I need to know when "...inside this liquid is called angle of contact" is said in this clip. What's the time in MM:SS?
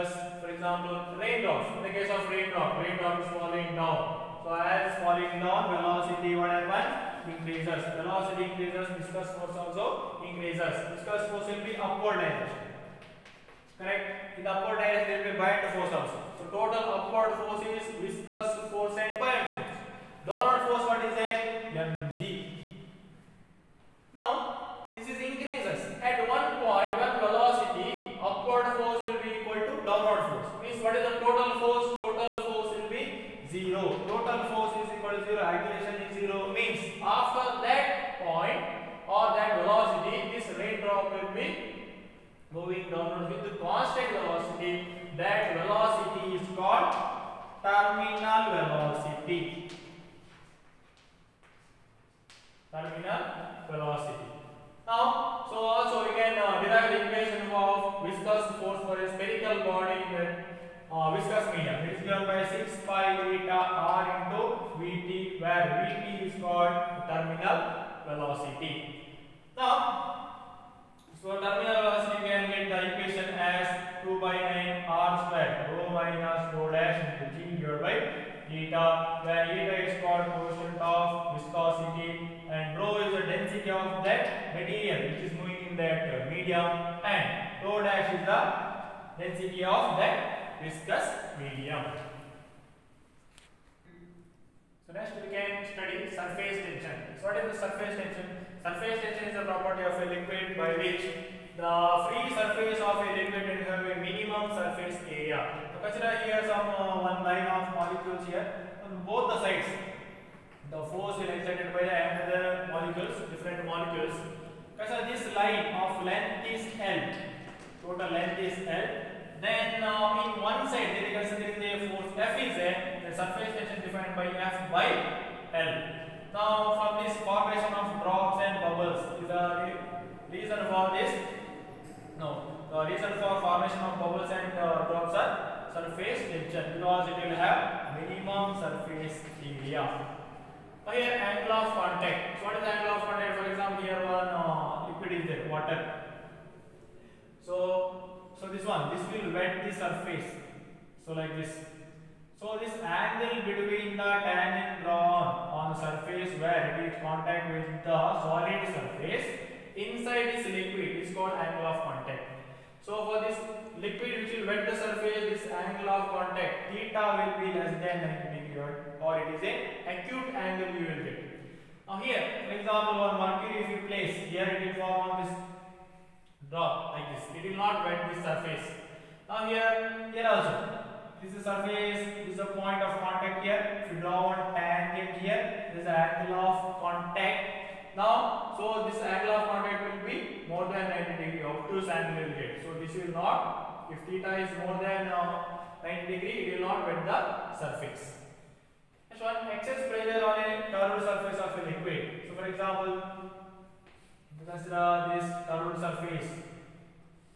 02:39.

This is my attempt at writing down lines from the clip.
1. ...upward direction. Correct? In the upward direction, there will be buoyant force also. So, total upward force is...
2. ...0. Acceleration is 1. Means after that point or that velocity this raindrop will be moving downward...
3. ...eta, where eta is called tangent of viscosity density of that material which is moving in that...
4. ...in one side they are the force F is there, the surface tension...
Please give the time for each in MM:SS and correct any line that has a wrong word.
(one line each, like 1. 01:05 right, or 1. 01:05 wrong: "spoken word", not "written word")
1. 00:11 right
2. 00:35 wrong: "0", not "1"
3. 01:18 wrong: "coefficient", not "tangent"
4. 02:00 right.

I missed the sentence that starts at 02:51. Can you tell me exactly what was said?
Now here, for example, when mercury if you place, here it will form on this drop like this.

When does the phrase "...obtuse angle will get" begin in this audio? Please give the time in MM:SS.
03:11.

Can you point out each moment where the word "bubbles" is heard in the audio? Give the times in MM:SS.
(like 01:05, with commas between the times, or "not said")
02:08, 02:13.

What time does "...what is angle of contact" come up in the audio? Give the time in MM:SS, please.
02:22.